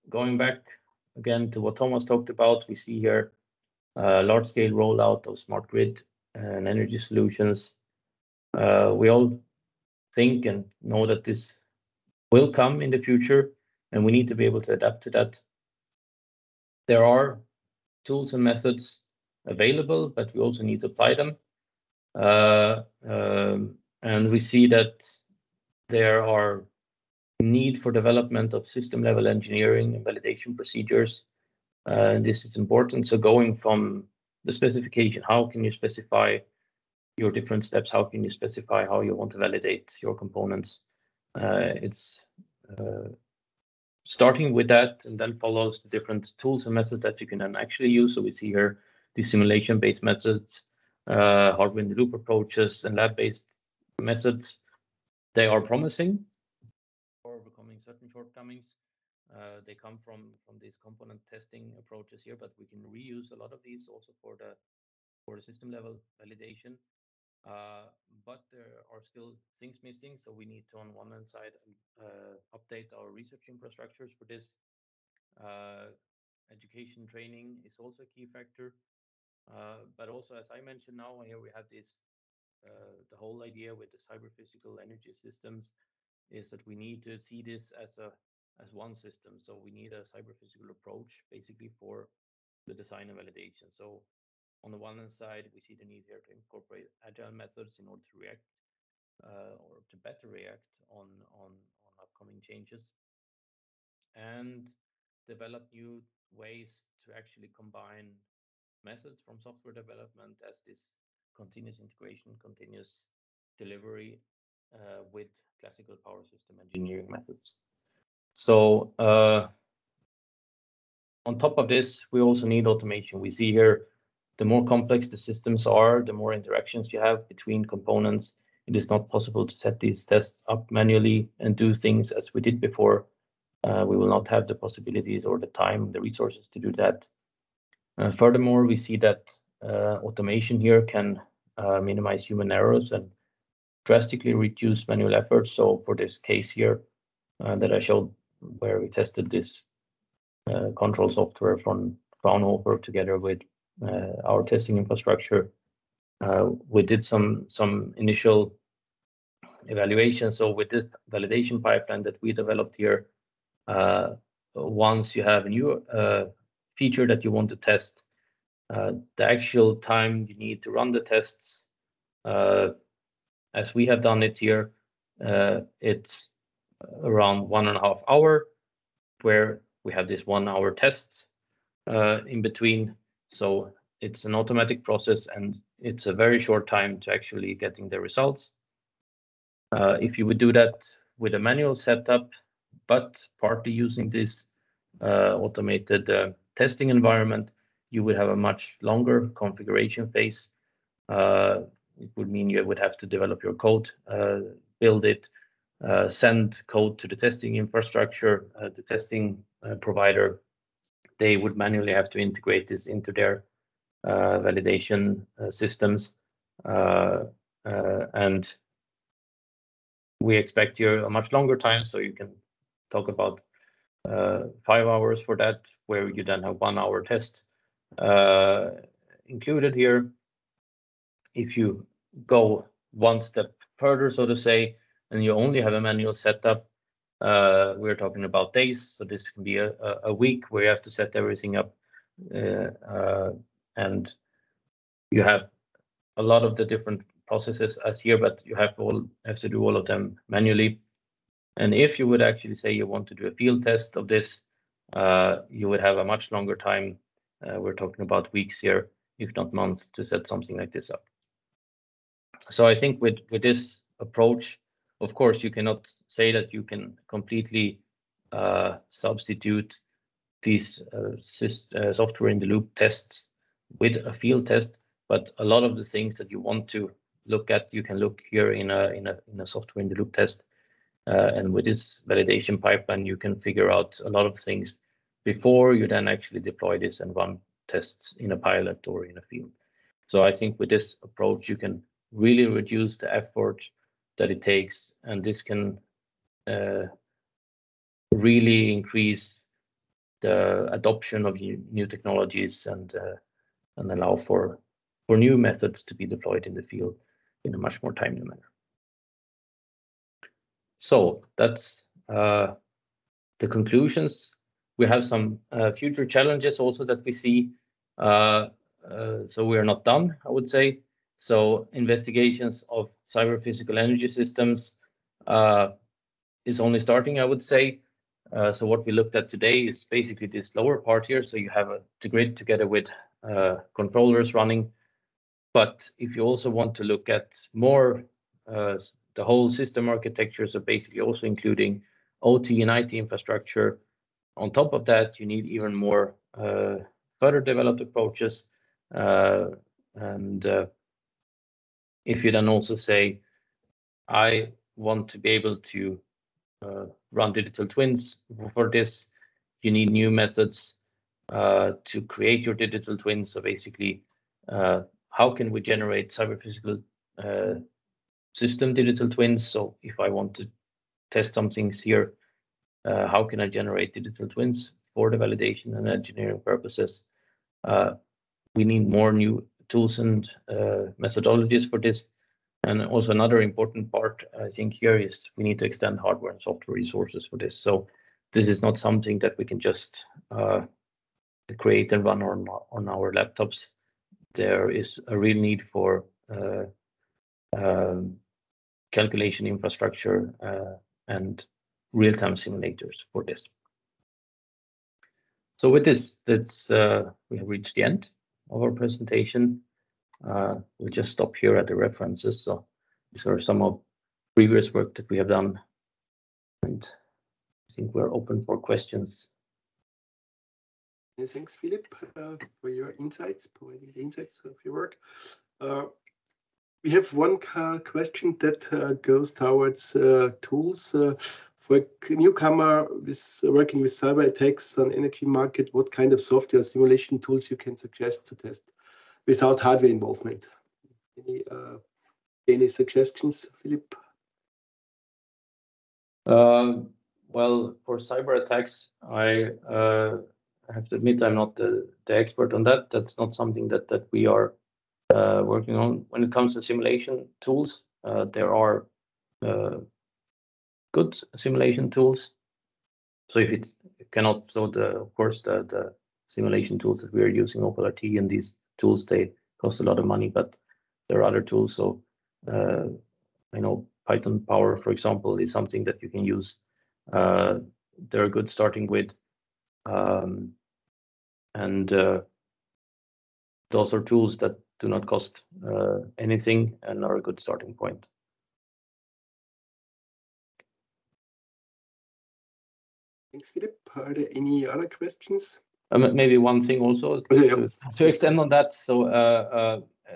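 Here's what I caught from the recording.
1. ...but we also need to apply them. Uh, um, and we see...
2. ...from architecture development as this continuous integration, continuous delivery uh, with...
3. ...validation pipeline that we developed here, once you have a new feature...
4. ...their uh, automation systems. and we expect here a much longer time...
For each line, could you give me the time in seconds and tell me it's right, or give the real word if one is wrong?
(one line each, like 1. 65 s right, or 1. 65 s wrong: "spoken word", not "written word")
1. 20 s right
2. 109 s wrong: "software", not "architecture"
3. 161 s right
4. 213 s wrong: "validation", not "automation".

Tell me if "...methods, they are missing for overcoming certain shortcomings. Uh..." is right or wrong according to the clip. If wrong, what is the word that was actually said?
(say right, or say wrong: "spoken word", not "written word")
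wrong: "promising", not "missing".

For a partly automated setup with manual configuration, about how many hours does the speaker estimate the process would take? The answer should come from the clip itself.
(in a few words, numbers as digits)
5 hours.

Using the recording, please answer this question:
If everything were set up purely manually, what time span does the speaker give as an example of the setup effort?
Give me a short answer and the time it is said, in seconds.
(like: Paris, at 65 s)
A week, at 240 s.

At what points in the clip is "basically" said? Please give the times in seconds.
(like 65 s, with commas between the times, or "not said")
91 s, 329 s, 340 s, 363 s.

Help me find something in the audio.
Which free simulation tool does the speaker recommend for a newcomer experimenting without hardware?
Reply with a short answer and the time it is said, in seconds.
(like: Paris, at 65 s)
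Python Power, at 474 s.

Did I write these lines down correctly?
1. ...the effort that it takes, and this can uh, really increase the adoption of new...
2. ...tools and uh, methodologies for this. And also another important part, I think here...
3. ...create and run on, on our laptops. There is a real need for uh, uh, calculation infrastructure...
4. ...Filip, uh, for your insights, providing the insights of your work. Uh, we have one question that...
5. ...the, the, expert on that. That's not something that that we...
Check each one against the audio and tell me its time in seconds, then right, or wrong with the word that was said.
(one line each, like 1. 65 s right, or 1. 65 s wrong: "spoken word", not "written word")
1. 292 s right
2. 379 s right
3. 391 s right
4. 421 s right
5. 451 s right.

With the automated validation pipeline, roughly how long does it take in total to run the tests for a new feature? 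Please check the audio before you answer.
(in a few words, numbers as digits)
1.5 hours.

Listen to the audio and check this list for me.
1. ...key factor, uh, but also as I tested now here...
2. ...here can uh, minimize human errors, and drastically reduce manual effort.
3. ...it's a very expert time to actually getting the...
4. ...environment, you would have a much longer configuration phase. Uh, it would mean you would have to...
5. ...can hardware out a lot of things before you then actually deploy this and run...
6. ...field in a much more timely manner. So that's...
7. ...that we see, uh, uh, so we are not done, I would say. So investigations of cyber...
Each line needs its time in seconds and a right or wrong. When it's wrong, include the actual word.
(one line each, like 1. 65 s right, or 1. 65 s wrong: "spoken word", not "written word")
1. 78 s wrong: "mentioned", not "tested"
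2. 140 s right
3. 185 s wrong: "short", not "expert"
4. 196 s right
5. 283 s wrong: "figure", not "hardware"
6. 306 s right
7. 316 s right.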